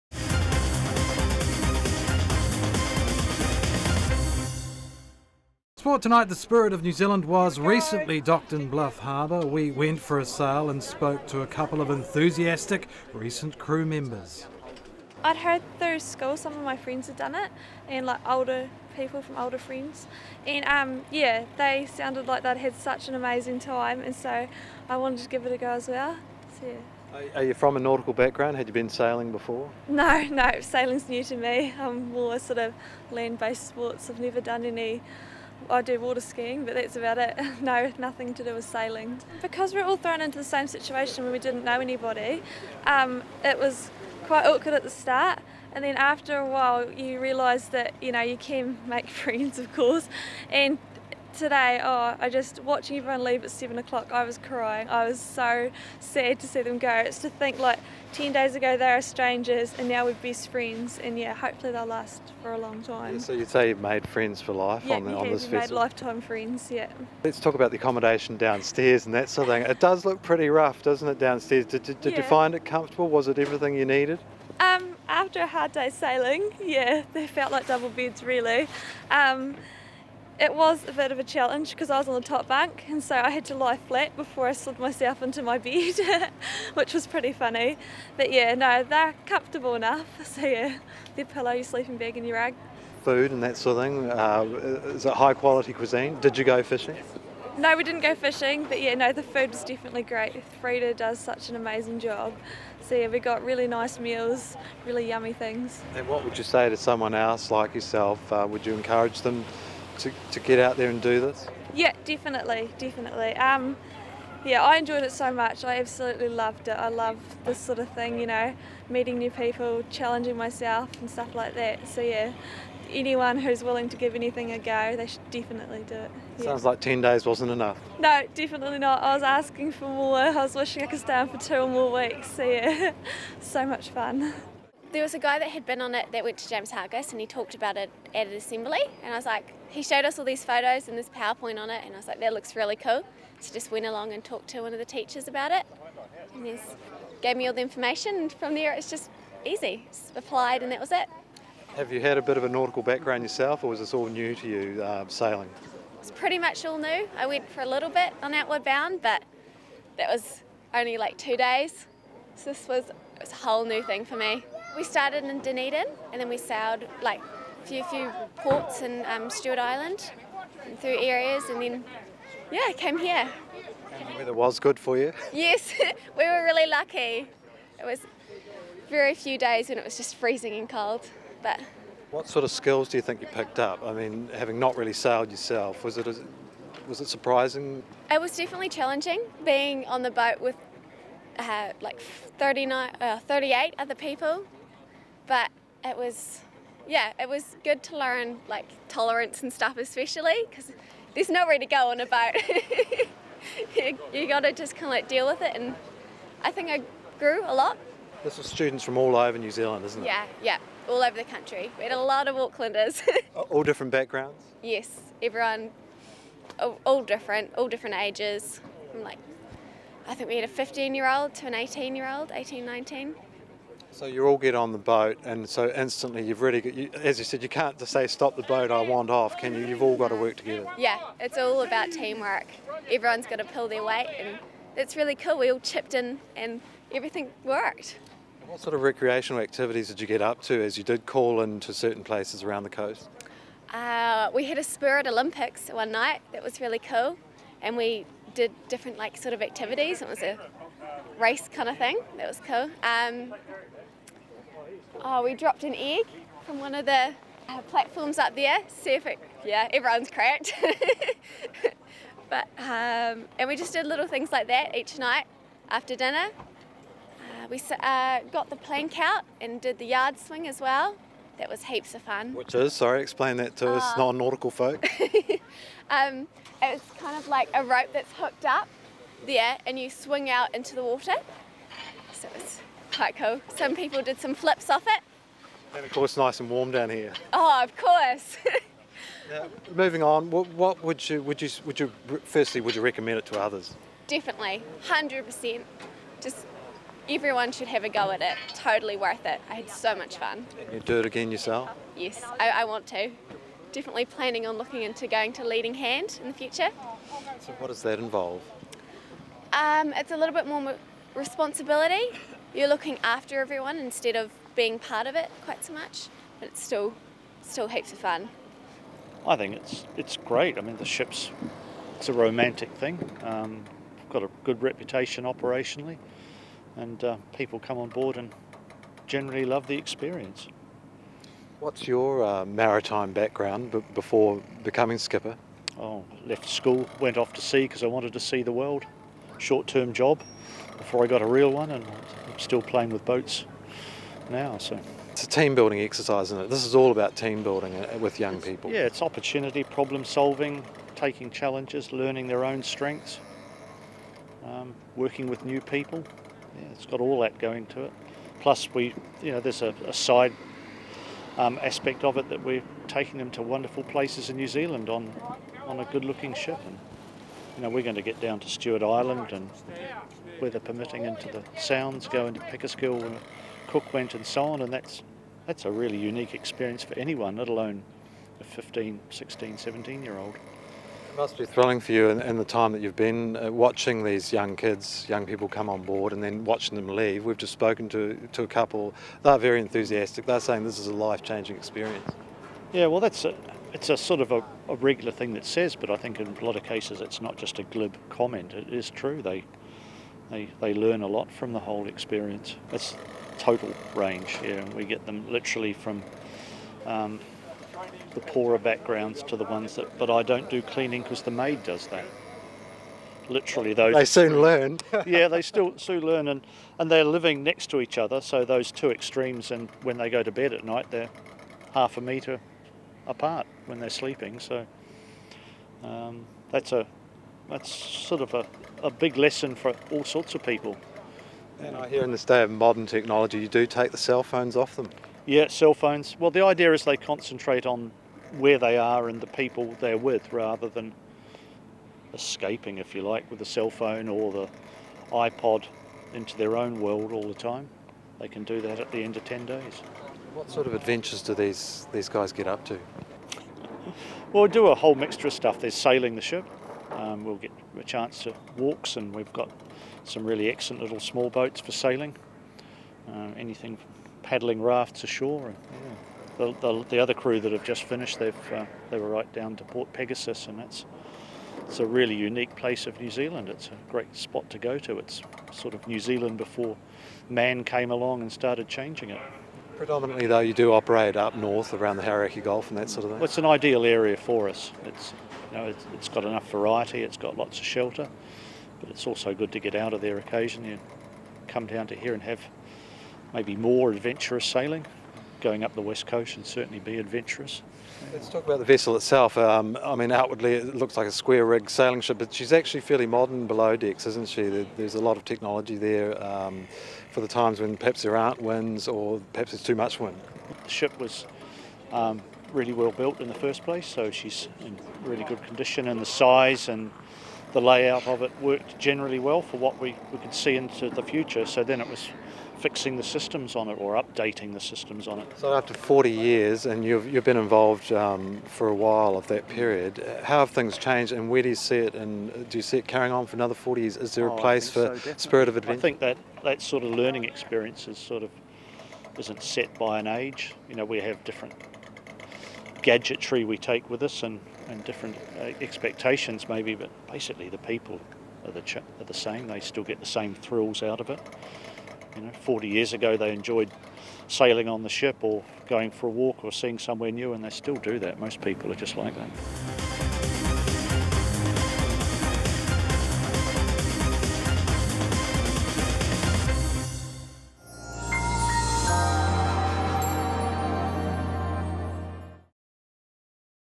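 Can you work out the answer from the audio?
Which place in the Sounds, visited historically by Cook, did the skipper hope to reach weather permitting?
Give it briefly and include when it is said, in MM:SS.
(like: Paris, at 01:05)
Pickersgill, at 06:12.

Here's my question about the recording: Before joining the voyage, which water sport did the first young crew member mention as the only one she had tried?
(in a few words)
water skiing.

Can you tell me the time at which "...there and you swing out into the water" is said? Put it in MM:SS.
04:39.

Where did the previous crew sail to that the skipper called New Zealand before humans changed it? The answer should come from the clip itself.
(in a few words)
Port Pegasus.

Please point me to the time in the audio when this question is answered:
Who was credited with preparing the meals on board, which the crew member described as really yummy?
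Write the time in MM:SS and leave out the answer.
01:40.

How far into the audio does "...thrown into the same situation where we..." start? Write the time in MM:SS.
00:39.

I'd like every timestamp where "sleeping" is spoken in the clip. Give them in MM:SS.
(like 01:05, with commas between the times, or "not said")
01:31, 07:03.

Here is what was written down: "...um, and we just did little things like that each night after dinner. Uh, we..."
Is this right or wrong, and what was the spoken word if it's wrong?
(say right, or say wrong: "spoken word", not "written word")
right.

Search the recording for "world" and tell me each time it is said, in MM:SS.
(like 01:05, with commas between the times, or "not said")
05:38, 07:26.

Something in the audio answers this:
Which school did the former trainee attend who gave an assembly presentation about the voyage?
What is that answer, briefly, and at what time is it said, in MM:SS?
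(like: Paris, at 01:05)
James Hargest, at 02:16.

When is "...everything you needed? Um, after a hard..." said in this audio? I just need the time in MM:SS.
01:13.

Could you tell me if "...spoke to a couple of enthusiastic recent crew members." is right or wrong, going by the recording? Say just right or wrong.
right.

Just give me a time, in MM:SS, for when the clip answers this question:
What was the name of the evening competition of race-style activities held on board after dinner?
04:04.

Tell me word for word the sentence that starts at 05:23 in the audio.
Um, got a good reputation operationally, and uh, people come on board and generally love the experience.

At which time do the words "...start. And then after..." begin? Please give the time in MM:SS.
00:44.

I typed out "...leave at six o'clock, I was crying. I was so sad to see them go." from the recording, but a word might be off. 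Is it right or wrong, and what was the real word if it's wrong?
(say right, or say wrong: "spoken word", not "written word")
wrong: "seven", not "six".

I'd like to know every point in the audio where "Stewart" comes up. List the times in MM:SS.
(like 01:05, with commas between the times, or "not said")
02:49, 06:08.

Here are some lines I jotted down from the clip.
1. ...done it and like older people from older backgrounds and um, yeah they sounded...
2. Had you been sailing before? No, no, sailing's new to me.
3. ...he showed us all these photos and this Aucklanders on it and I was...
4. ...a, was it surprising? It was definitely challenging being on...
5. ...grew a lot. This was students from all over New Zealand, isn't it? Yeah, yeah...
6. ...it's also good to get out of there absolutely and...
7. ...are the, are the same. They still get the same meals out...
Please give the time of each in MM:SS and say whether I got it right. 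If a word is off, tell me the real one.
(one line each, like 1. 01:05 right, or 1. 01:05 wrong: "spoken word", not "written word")
1. 00:17 wrong: "friends", not "backgrounds"
2. 00:28 right
3. 02:19 wrong: "PowerPoint", not "Aucklanders"
4. 03:06 right
5. 03:27 right
6. 08:08 wrong: "occasionally", not "absolutely"
7. 09:08 wrong: "thrills", not "meals".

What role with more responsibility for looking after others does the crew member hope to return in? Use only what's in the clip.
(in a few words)
Leading Hand.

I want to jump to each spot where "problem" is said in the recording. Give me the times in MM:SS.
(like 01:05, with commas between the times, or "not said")
05:49.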